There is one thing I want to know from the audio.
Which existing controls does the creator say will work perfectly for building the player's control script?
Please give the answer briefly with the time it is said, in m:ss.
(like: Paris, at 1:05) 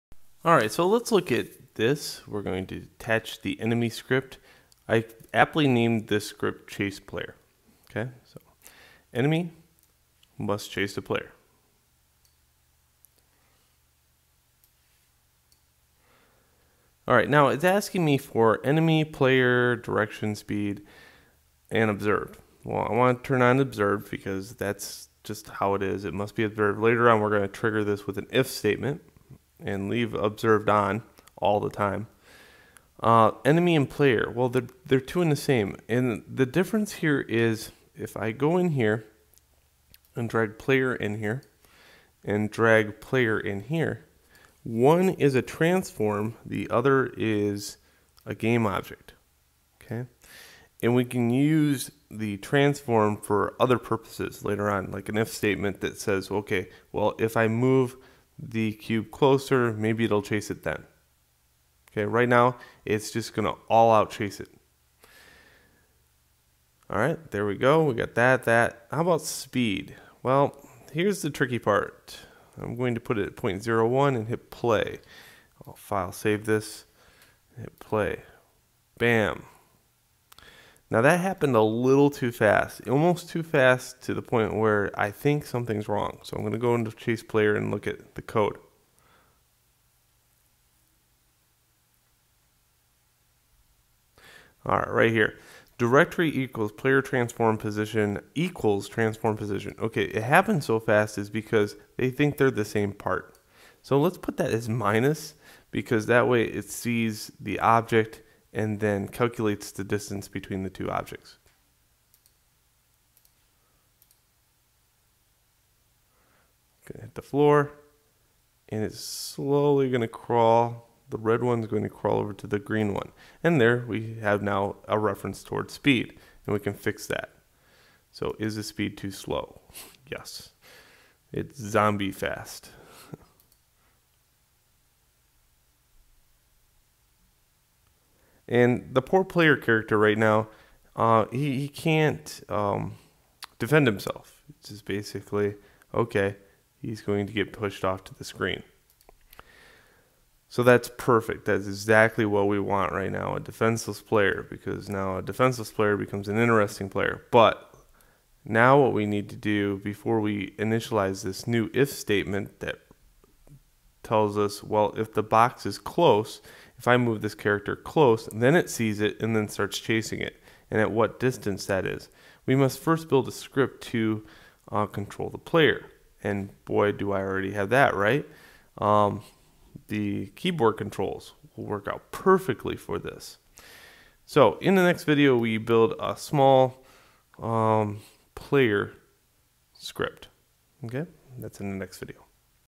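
keyboard controls, at 3:00.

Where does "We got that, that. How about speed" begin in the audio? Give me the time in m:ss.
1:07.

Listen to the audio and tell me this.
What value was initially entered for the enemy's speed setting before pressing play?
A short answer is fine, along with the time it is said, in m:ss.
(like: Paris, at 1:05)
0.01, at 1:13.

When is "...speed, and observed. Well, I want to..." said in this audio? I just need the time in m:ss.
0:20.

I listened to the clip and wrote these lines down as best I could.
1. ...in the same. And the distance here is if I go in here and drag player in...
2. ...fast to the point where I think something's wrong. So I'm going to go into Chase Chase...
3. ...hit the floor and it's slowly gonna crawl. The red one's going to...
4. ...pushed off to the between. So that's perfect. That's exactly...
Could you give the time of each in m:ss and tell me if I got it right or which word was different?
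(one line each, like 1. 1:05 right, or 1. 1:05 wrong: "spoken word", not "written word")
1. 0:35 wrong: "difference", not "distance"
2. 1:23 wrong: "Player", not "Chase"
3. 1:57 right
4. 2:27 wrong: "screen", not "between".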